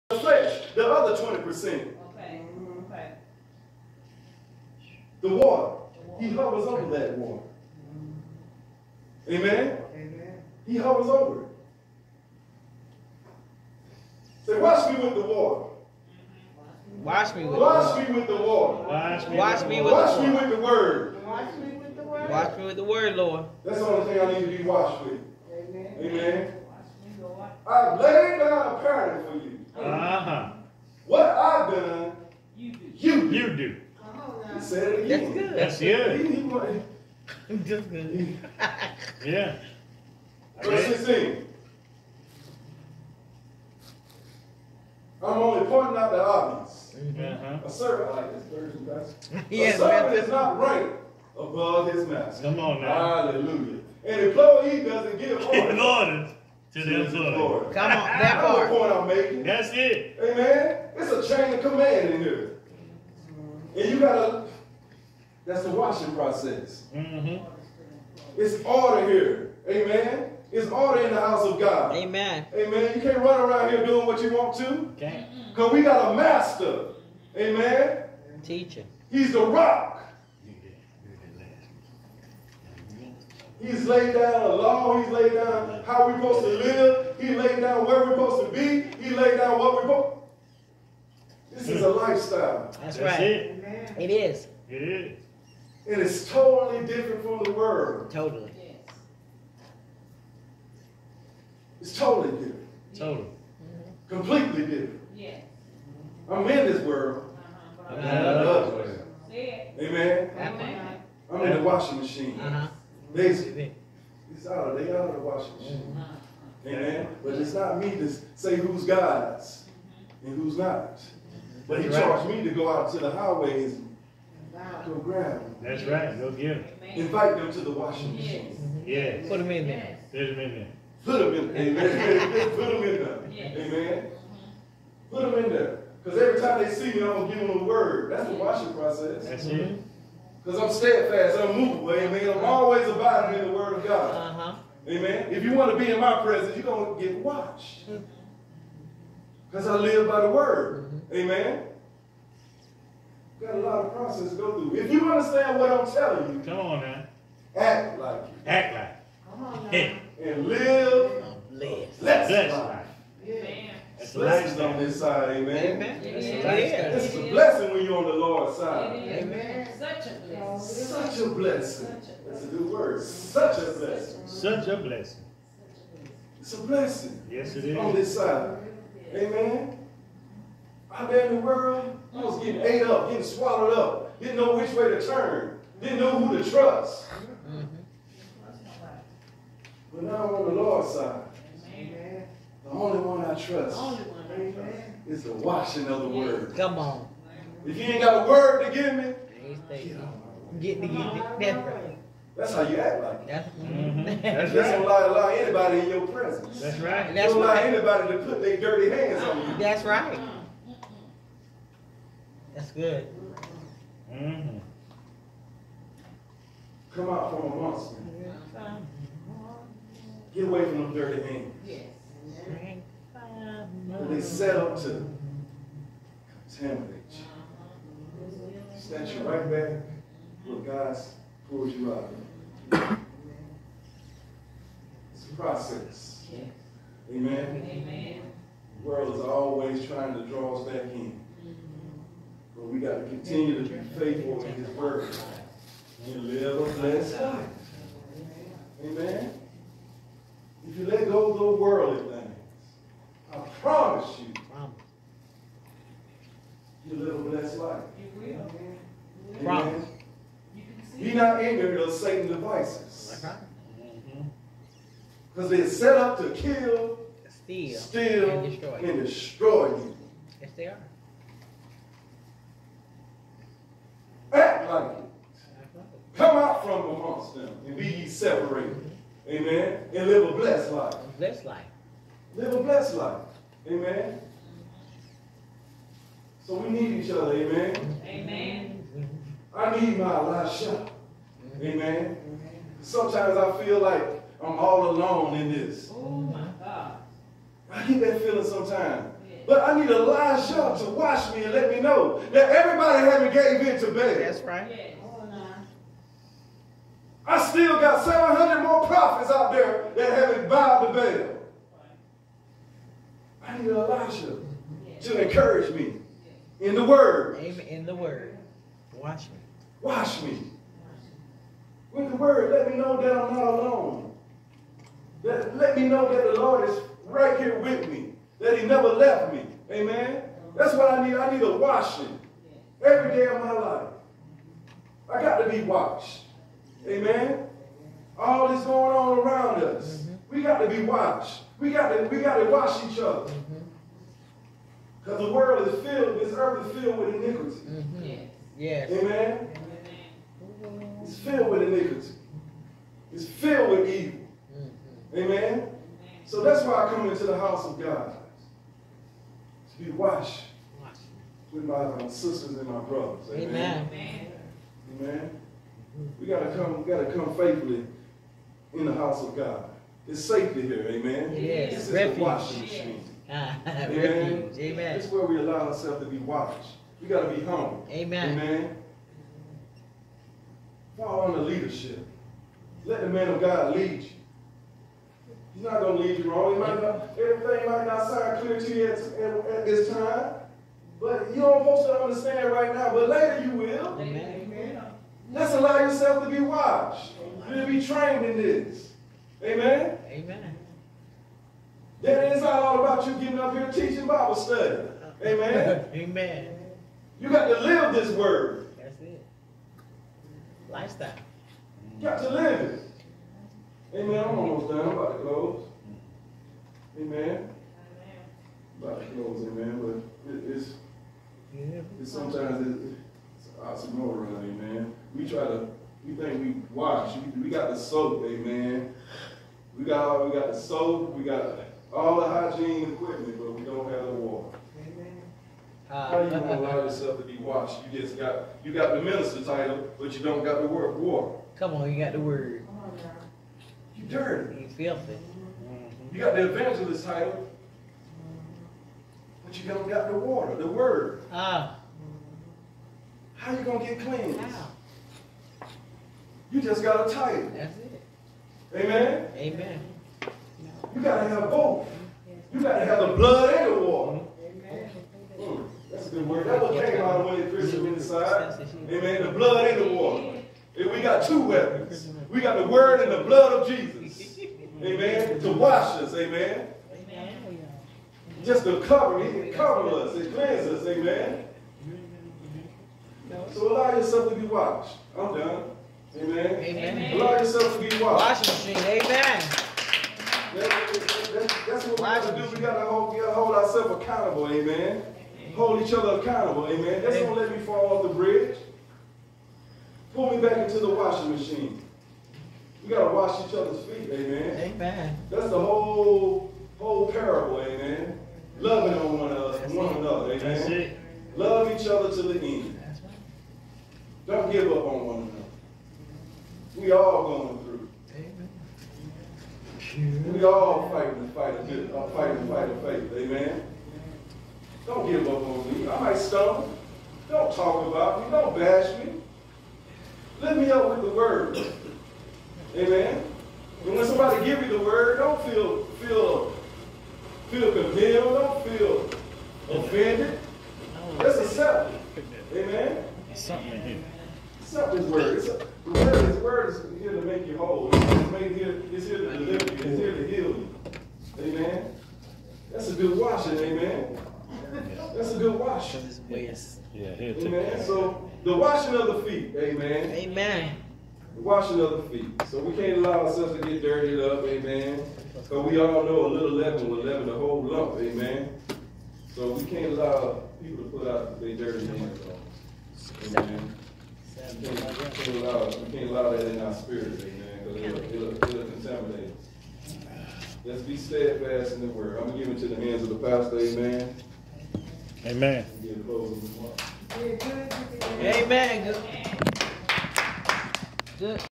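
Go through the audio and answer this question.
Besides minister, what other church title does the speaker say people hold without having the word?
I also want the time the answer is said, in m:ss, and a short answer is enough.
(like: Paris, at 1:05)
Evangelist, at 7:26.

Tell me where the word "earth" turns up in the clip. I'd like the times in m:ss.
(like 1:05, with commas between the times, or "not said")
5:46.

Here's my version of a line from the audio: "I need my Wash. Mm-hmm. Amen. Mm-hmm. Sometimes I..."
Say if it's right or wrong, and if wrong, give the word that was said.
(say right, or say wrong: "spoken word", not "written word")
wrong: "Elisha", not "Wash".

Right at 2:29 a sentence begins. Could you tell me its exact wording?
Because I live by the word.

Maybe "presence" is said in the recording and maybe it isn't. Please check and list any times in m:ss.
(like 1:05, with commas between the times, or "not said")
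2:26, 3:26.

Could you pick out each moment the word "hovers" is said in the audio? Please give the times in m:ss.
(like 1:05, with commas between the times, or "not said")
0:06, 0:10.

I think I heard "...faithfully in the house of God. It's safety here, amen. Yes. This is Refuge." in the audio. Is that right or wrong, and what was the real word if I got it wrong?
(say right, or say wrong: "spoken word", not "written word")
right.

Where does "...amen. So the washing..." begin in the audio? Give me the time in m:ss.
9:17.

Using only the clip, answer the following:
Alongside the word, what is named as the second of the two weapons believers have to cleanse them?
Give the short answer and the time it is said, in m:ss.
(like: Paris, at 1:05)
The blood of Jesus, at 7:53.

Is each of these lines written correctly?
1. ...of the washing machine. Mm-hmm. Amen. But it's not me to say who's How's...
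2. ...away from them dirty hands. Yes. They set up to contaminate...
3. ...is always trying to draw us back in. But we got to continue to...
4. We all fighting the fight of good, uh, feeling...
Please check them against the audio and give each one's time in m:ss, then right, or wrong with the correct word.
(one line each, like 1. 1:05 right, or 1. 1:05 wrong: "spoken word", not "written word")
1. 1:55 wrong: "God", not "How"
2. 3:40 right
3. 3:59 right
4. 8:40 wrong: "fighting", not "feeling".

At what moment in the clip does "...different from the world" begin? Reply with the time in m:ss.
1:36.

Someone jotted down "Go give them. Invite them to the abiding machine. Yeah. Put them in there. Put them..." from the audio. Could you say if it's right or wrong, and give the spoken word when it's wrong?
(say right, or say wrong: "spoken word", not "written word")
wrong: "washing", not "abiding".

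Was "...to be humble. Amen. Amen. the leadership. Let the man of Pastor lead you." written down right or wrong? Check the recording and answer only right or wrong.
wrong.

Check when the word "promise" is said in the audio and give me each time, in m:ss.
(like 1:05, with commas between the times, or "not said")
4:13, 4:19.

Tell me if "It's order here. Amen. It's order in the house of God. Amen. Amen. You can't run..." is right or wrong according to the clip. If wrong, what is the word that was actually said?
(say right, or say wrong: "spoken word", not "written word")
right.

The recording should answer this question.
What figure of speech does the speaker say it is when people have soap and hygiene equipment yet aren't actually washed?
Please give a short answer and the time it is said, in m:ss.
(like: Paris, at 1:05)
Oxymoron, at 7:03.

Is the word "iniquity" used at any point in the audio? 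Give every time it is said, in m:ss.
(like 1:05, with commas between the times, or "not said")
5:47, 5:51.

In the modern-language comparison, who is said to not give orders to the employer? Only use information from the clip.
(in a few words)
An employee.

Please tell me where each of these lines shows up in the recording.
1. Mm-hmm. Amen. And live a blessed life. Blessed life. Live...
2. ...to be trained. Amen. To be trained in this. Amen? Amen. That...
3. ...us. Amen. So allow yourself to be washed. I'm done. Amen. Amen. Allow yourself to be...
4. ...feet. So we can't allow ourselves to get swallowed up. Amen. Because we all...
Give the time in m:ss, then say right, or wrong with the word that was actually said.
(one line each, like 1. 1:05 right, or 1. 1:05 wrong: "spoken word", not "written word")
1. 4:38 right
2. 6:36 wrong: "watched", not "trained"
3. 8:00 right
4. 9:22 wrong: "dirtied", not "swallowed".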